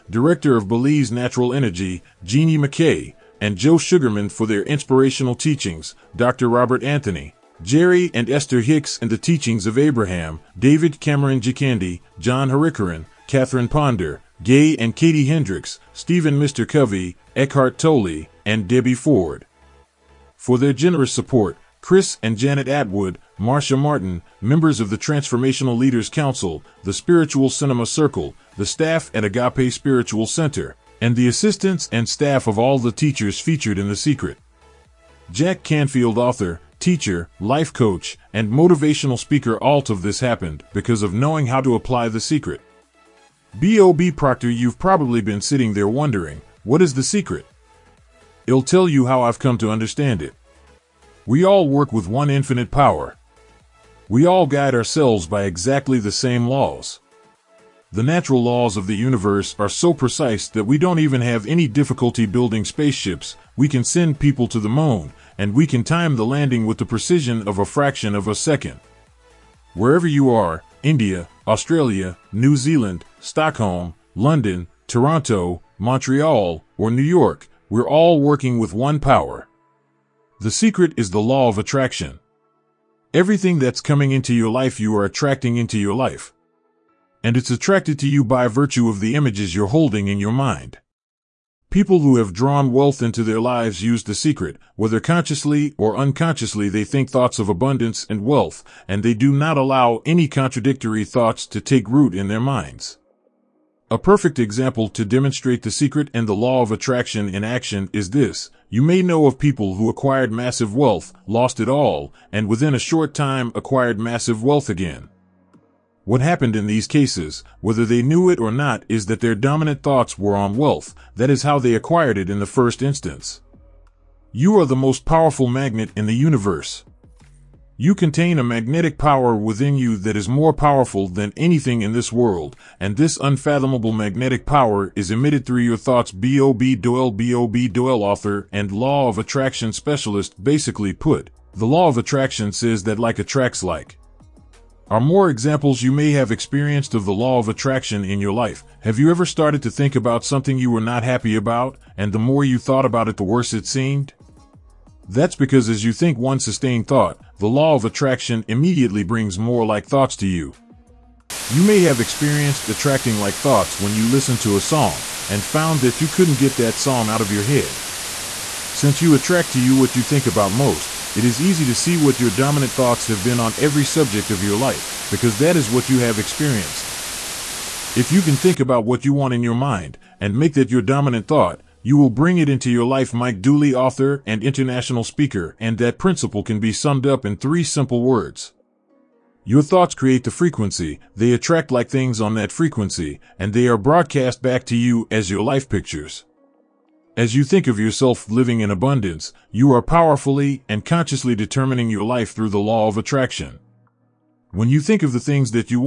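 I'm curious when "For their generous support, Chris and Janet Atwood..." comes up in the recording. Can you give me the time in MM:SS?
00:20.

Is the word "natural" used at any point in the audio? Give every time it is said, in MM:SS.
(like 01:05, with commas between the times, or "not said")
00:01, 00:58.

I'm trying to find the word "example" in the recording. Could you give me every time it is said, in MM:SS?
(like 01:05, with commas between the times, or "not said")
01:44, 02:25.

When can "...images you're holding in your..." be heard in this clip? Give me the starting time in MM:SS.
01:29.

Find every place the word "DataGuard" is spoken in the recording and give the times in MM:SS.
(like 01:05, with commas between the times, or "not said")
not said.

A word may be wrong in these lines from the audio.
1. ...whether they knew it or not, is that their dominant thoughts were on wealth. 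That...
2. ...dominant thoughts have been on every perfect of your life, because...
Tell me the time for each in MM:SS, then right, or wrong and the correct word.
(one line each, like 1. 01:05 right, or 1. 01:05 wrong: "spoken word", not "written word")
1. 01:57 right
2. 02:52 wrong: "subject", not "perfect".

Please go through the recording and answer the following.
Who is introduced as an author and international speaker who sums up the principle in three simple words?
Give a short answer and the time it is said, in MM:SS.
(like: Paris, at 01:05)
Mike Dooley, at 03:03.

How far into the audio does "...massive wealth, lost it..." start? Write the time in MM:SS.
01:50.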